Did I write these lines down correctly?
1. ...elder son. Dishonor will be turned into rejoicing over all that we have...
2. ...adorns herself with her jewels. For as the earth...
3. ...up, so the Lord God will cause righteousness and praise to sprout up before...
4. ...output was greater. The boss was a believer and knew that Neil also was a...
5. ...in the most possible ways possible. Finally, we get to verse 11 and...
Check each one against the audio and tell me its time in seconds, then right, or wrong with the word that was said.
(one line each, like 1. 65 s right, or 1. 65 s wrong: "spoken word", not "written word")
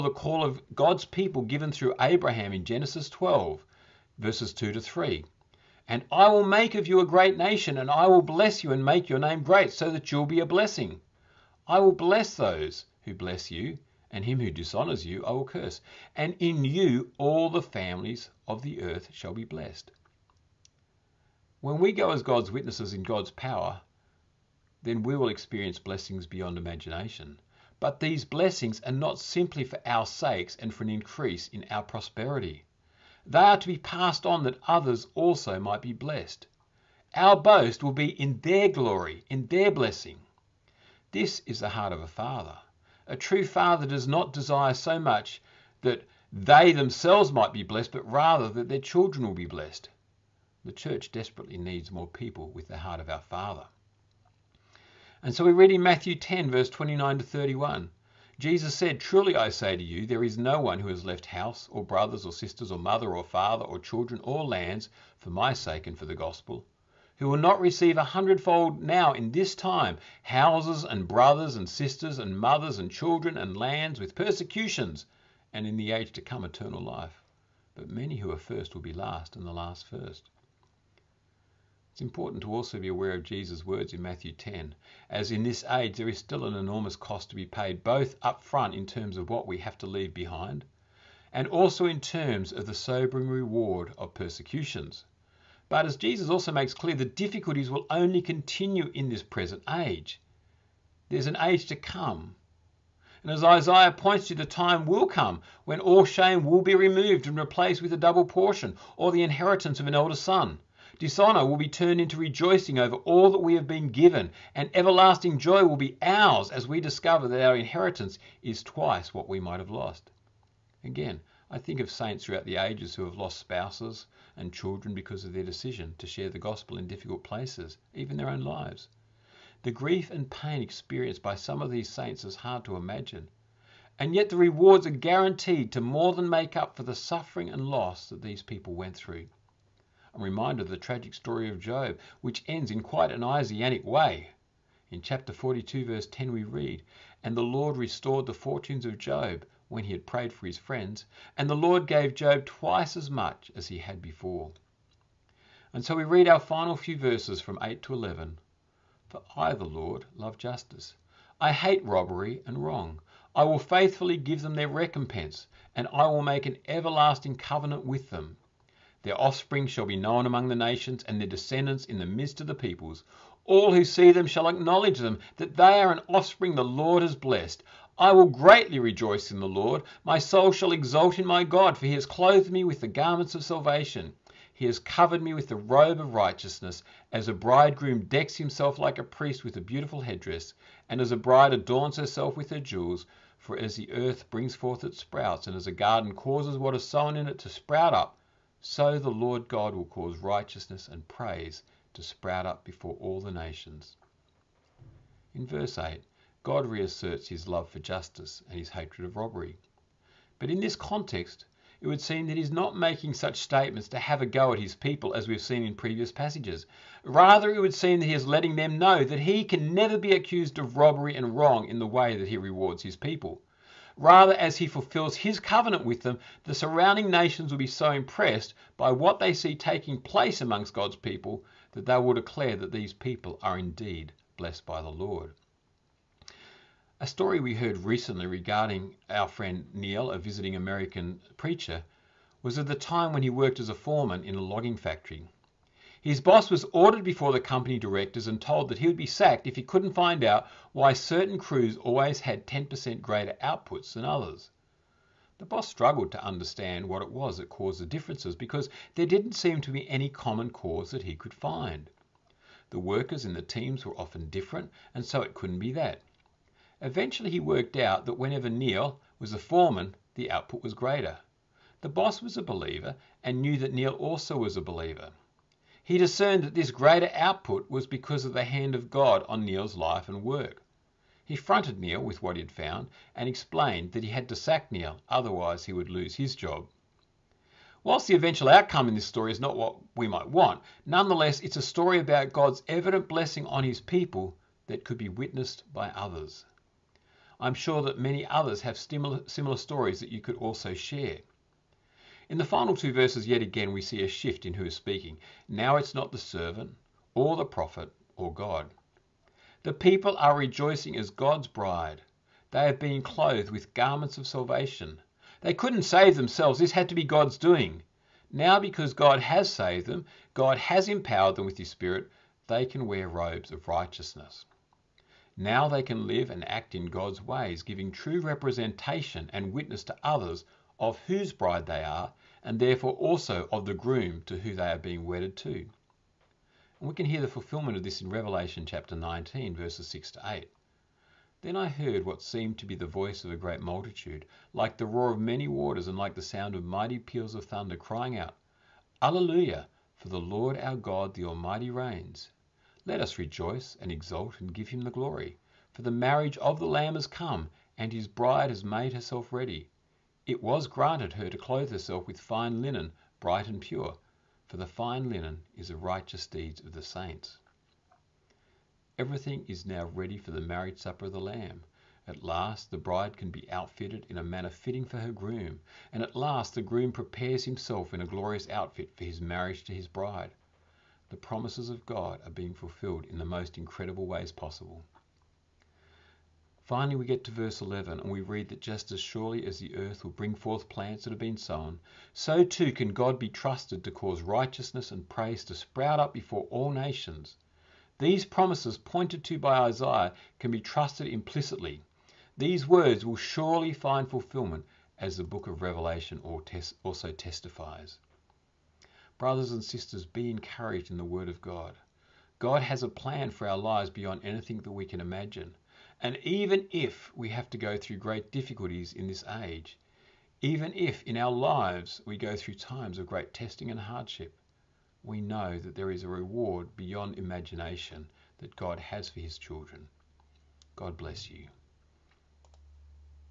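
1. 109 s right
2. 191 s right
3. 197 s right
4. 270 s right
5. 383 s wrong: "incredible", not "possible".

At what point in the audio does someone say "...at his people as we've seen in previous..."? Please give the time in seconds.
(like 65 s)
214 s.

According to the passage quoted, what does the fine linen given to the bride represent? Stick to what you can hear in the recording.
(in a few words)
Righteous deeds of the saints.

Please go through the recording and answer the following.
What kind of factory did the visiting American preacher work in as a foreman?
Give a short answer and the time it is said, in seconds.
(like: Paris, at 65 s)
Logging factory, at 244 s.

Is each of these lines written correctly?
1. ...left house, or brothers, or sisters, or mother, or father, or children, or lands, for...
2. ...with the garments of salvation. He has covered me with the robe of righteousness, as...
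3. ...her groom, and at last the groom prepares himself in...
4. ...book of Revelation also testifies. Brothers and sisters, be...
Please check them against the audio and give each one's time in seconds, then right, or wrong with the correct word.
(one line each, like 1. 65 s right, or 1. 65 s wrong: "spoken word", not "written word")
1. 61 s right
2. 182 s right
3. 374 s right
4. 405 s right.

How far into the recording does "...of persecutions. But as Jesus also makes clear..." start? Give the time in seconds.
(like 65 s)
93 s.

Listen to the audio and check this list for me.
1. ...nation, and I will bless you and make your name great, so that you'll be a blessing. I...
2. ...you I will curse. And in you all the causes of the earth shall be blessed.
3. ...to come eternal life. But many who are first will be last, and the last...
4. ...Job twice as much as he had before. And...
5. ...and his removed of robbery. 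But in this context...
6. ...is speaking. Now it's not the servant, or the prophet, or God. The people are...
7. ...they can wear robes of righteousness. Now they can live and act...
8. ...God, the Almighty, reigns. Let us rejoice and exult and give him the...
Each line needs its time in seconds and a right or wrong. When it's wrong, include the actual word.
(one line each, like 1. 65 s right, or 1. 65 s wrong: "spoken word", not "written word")
1. 7 s right
2. 15 s wrong: "families", not "causes"
3. 76 s right
4. 152 s right
5. 208 s wrong: "hatred", not "removed"
6. 304 s right
7. 322 s right
8. 350 s right.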